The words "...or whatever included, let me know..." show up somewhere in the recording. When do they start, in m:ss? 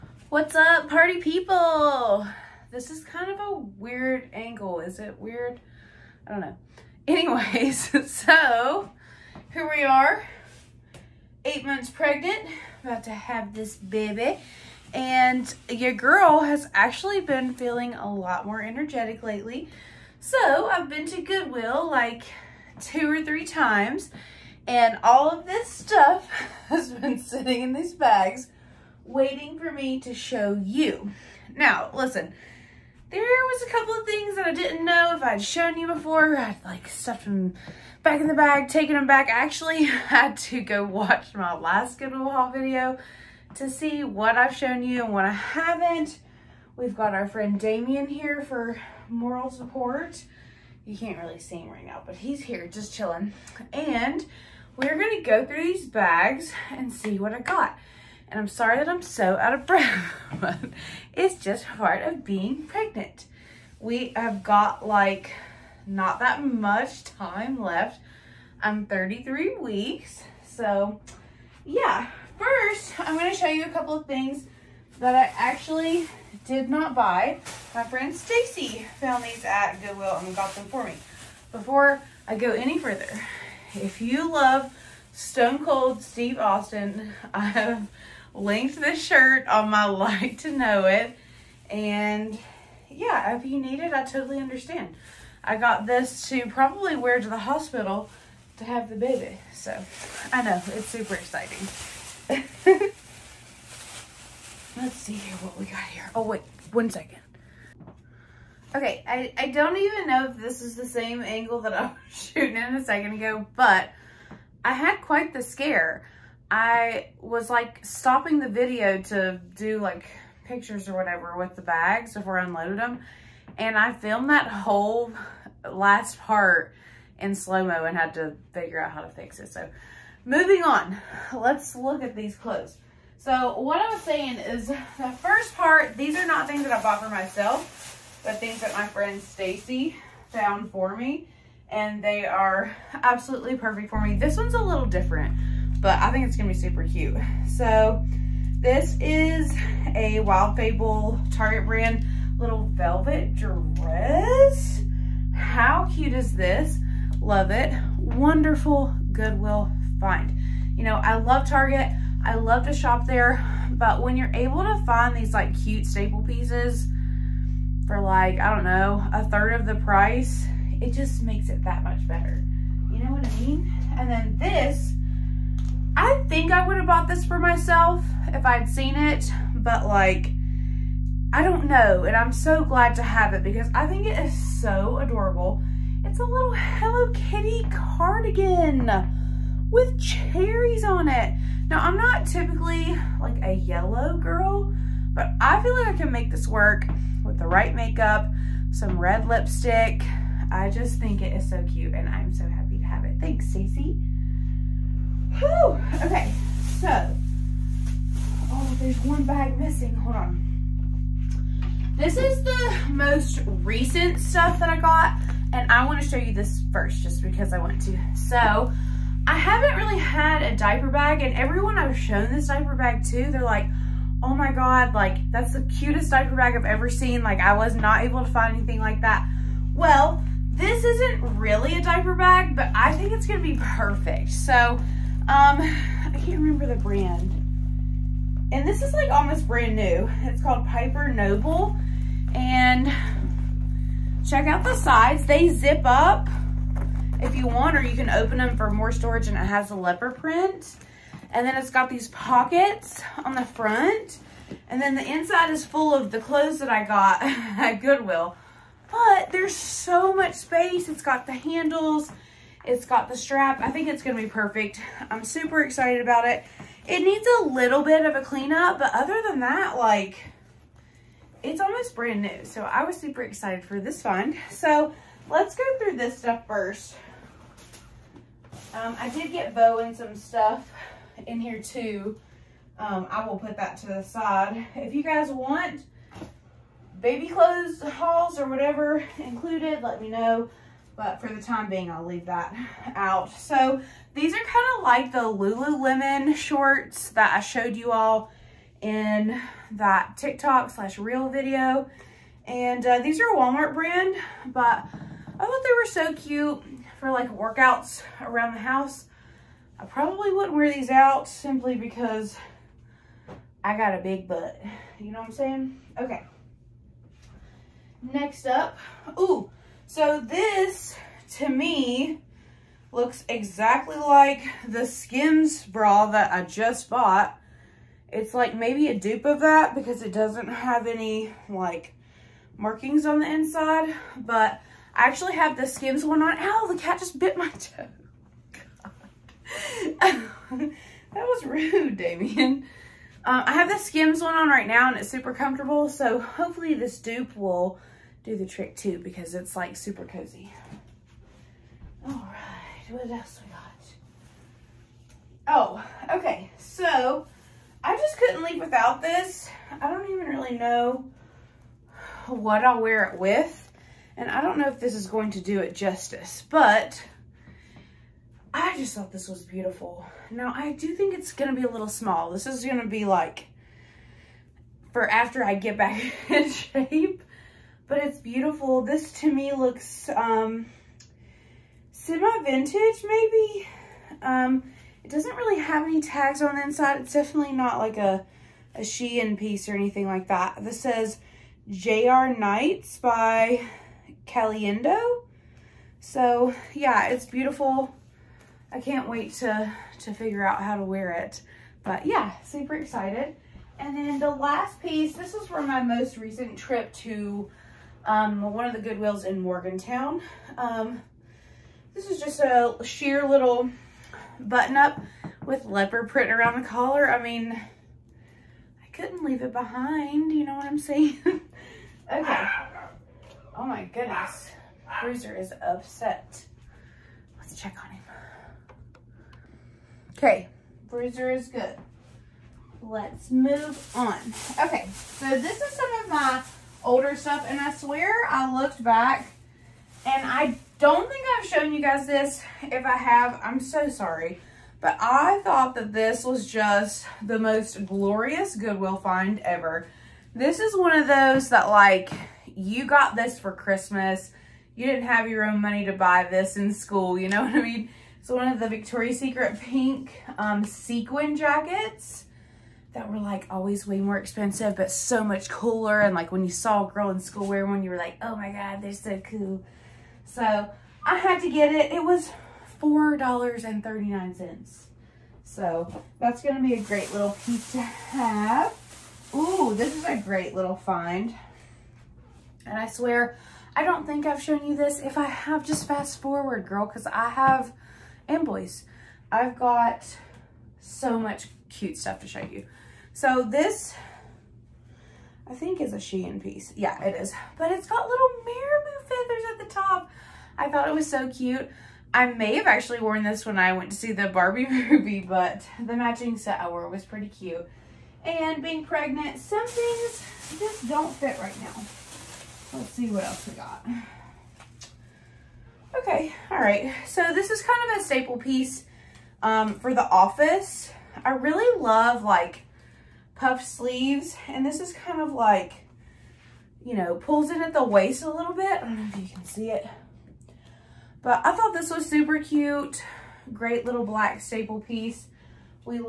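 4:48.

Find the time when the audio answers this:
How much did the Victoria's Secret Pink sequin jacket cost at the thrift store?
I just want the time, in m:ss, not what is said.
7:52.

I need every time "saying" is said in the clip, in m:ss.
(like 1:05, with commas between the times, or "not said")
2:14, 5:15, 7:00.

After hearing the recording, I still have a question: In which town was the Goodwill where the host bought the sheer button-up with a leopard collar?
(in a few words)
Morgantown.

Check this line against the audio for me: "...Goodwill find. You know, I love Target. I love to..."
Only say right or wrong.
right.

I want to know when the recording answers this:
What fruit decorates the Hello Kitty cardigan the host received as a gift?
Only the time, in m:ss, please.
3:09.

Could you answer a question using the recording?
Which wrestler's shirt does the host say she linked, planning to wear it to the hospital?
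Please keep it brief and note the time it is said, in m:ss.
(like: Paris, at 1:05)
Stone Cold Steve Austin, at 1:25.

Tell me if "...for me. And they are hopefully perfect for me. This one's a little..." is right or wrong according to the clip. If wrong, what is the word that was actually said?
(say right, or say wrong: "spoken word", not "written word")
wrong: "absolutely", not "hopefully".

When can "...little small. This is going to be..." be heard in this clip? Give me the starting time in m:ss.
6:11.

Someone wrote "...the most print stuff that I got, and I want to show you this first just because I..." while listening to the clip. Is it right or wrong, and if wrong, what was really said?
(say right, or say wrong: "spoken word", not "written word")
wrong: "recent", not "print".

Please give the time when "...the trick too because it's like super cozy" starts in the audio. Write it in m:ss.
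5:48.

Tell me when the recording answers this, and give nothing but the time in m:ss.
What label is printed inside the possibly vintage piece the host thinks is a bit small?
6:31.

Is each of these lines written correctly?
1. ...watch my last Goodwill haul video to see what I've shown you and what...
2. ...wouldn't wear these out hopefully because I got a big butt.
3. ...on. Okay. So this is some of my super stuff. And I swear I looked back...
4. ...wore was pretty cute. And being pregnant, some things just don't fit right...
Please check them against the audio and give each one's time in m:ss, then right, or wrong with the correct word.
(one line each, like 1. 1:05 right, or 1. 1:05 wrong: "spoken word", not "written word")
1. 0:40 right
2. 5:10 wrong: "simply", not "hopefully"
3. 7:13 wrong: "older", not "super"
4. 8:26 right.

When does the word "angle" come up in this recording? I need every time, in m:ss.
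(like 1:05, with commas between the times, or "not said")
0:04, 1:51.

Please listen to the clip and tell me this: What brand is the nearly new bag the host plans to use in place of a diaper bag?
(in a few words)
Piper Noble.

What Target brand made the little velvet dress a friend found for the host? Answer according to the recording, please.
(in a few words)
Wild Fable.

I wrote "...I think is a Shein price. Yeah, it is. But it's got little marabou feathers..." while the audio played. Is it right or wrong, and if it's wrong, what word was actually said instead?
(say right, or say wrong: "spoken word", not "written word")
wrong: "piece", not "price".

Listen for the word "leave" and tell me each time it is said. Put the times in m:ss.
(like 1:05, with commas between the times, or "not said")
4:52, 5:58, 6:59.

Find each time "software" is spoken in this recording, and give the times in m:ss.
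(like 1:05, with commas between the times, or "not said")
not said.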